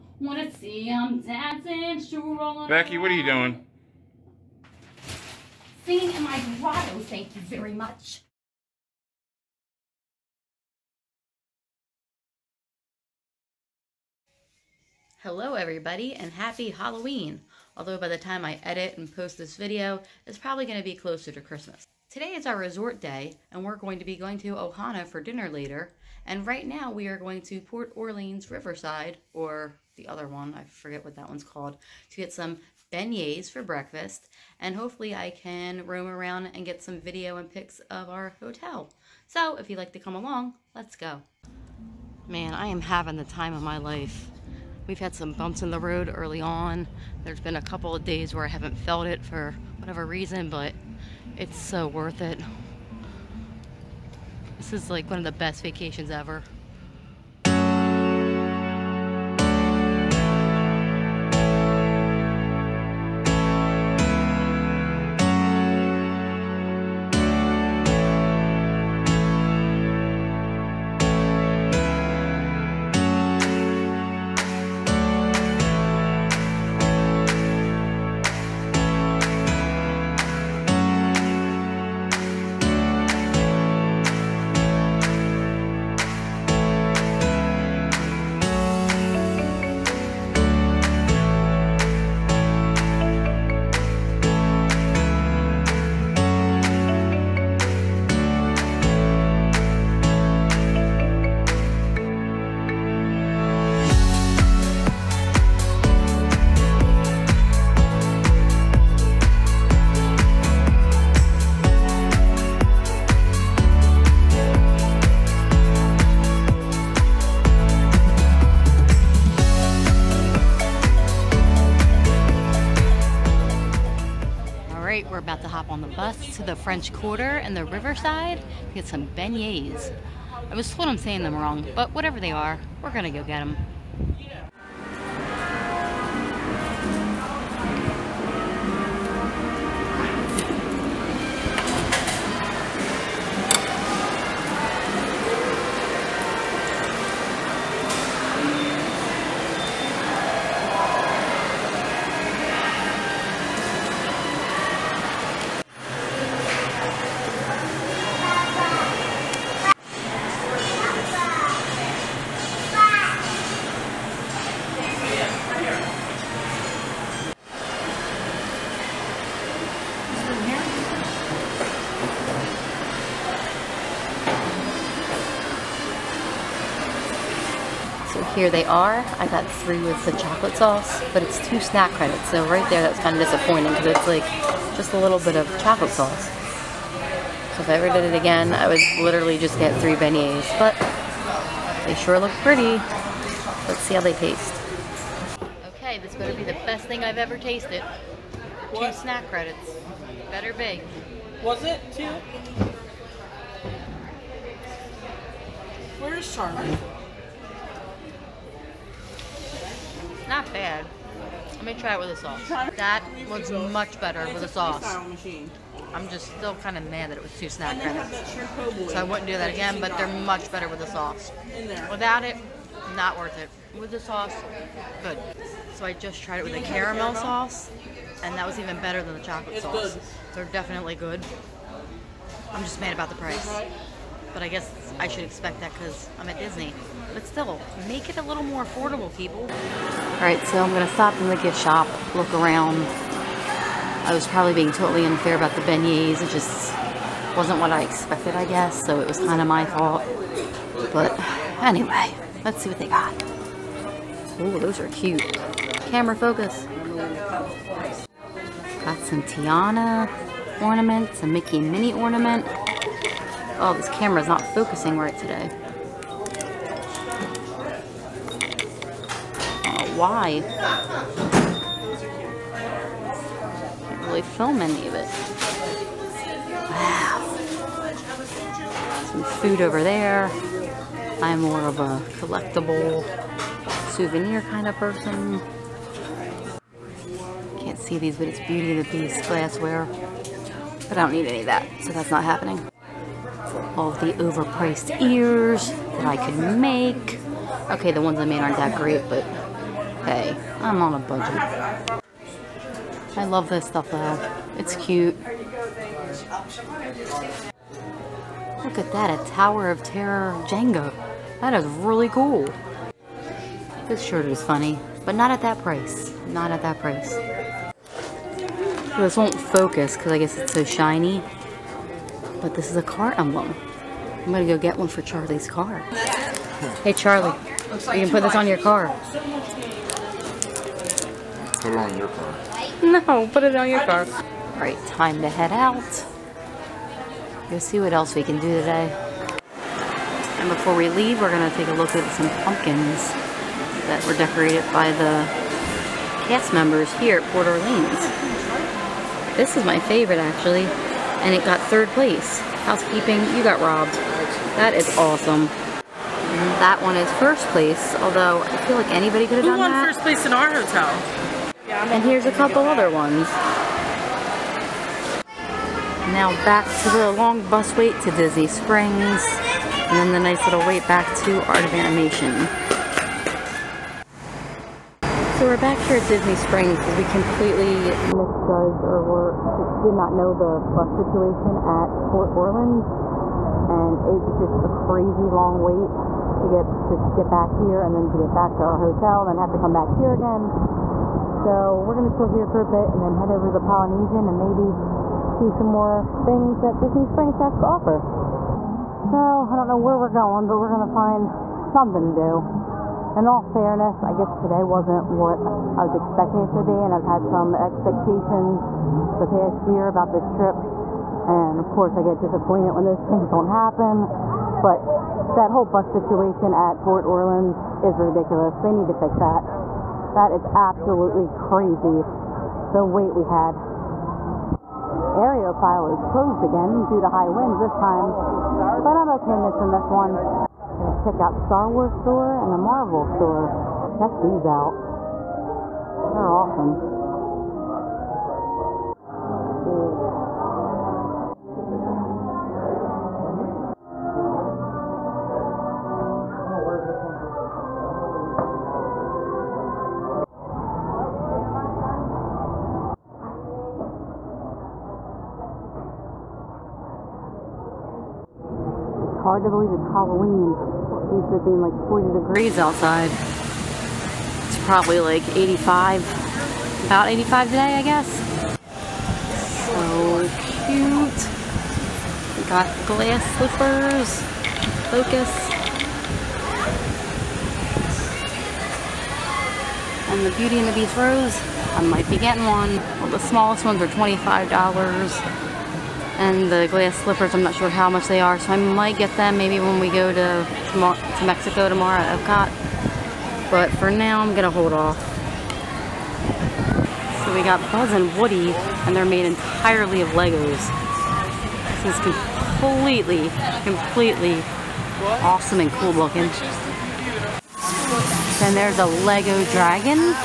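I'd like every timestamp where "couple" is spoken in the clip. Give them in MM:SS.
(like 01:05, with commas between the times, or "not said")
00:47, 06:02.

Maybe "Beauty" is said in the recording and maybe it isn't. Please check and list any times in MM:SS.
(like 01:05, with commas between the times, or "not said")
04:48, 08:00.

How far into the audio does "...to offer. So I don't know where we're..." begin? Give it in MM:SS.
06:37.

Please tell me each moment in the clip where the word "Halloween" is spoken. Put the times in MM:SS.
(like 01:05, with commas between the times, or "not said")
00:16, 07:39.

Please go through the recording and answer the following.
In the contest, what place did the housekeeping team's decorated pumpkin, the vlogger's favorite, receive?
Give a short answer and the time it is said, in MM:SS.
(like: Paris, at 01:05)
Third place, at 05:51.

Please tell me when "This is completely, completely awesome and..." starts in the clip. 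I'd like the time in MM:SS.
08:21.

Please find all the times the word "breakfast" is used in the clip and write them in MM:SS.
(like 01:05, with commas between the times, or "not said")
00:33.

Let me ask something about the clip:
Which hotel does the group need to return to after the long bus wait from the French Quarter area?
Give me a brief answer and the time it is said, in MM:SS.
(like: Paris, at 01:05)
Art of Animation, at 06:11.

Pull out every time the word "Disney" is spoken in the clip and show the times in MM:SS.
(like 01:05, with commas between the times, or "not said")
03:56, 06:08, 06:16, 06:36.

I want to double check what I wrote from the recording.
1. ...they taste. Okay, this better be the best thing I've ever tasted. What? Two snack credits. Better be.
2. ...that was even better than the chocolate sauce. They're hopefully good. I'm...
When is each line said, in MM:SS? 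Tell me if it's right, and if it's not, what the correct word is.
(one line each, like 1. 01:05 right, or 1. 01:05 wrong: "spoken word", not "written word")
1. 03:14 right
2. 03:48 wrong: "definitely", not "hopefully".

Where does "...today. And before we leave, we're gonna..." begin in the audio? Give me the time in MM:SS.
05:38.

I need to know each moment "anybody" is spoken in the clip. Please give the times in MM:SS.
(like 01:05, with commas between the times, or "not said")
05:58.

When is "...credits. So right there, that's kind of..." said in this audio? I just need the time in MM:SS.
03:01.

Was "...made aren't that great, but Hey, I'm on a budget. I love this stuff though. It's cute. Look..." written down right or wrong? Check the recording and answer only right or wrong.
right.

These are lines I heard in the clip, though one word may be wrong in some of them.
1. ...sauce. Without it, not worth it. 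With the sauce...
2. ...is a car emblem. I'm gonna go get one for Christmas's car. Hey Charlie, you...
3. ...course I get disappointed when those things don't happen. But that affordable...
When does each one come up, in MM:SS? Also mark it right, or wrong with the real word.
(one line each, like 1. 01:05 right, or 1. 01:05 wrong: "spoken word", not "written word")
1. 03:40 right
2. 05:22 wrong: "Charlie", not "Christmas"
3. 06:51 wrong: "whole", not "affordable".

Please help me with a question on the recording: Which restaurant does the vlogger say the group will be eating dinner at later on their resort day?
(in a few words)
Ohana.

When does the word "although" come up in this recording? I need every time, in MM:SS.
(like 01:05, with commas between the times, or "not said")
00:17, 05:57.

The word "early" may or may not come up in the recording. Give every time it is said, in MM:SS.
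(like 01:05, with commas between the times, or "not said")
00:46.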